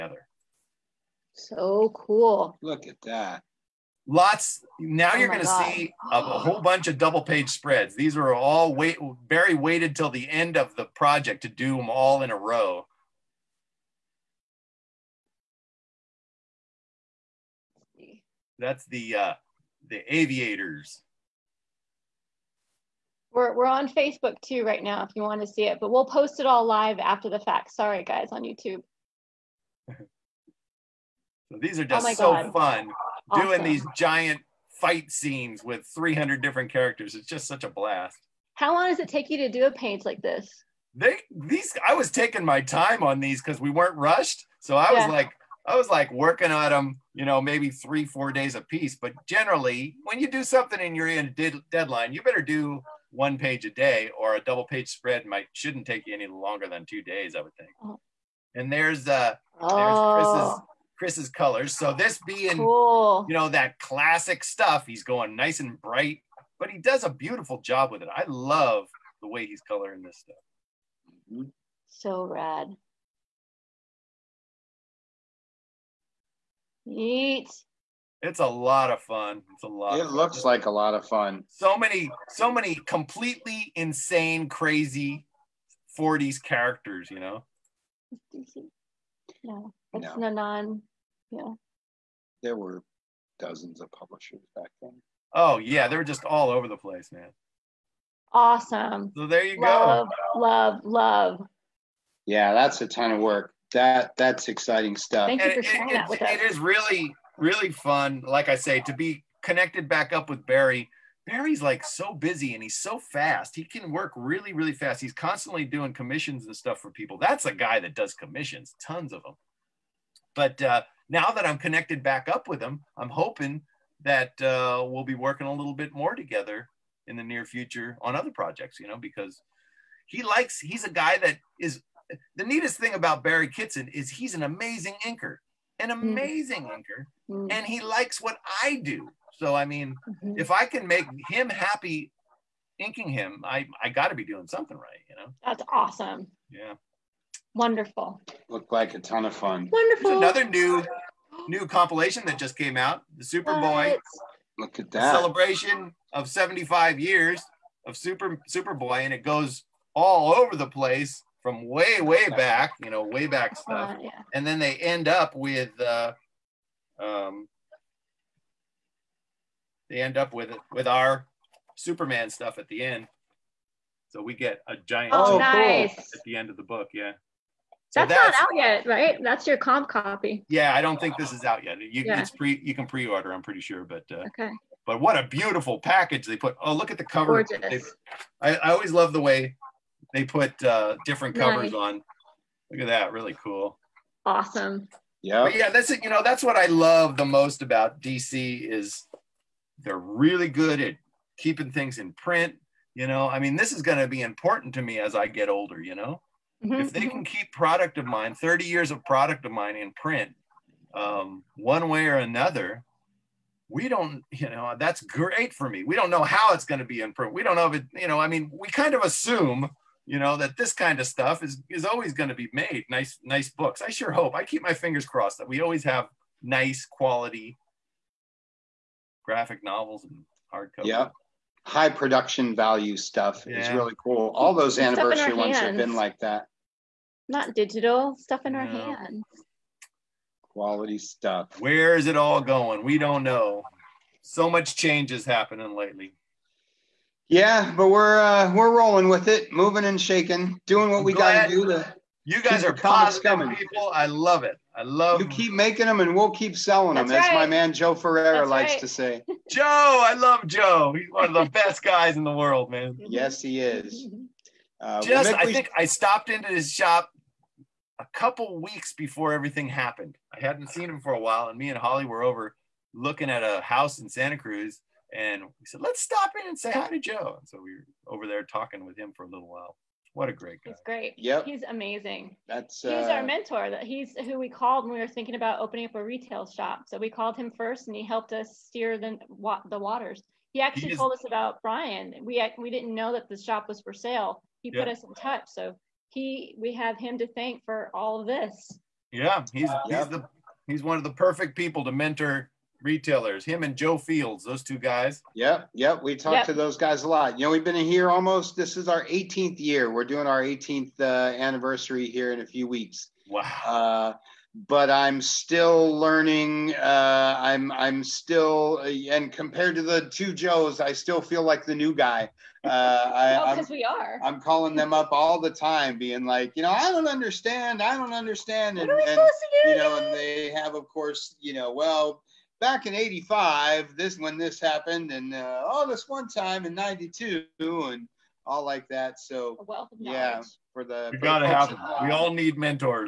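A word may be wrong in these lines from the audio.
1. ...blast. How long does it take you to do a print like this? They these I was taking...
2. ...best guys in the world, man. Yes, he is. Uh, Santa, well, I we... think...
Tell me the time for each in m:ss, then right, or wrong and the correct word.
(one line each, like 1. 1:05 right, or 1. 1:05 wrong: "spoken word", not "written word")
1. 0:37 wrong: "paint", not "print"
2. 4:21 wrong: "Just", not "Santa".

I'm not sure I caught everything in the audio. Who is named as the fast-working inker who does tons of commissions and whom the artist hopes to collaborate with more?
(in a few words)
Barry Kitson.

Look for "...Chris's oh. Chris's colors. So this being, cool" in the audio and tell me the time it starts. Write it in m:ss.
1:00.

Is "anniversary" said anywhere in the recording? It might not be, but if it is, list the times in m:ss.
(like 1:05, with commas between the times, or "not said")
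3:54, 5:11.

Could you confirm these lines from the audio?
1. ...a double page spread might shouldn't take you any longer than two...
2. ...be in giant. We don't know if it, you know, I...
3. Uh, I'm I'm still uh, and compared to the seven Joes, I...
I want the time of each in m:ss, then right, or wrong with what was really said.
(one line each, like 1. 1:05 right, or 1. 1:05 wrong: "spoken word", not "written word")
1. 0:54 right
2. 3:36 wrong: "print", not "giant"
3. 5:16 wrong: "two", not "seven".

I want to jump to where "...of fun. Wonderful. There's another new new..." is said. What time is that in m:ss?
2:29.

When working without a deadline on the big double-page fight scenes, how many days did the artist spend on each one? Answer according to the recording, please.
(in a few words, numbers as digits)
3 or 4 days.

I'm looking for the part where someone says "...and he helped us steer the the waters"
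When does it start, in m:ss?
4:47.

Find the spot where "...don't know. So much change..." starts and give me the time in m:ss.
4:02.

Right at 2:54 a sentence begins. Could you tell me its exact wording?
So we get a giant oh, nice.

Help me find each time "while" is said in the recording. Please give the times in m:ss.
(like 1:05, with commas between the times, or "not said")
4:31, 4:39.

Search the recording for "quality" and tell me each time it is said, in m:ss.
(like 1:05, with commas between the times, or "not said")
3:46, 4:00.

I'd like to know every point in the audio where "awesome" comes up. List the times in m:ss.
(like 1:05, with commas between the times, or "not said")
0:33, 1:38, 2:25, 3:14.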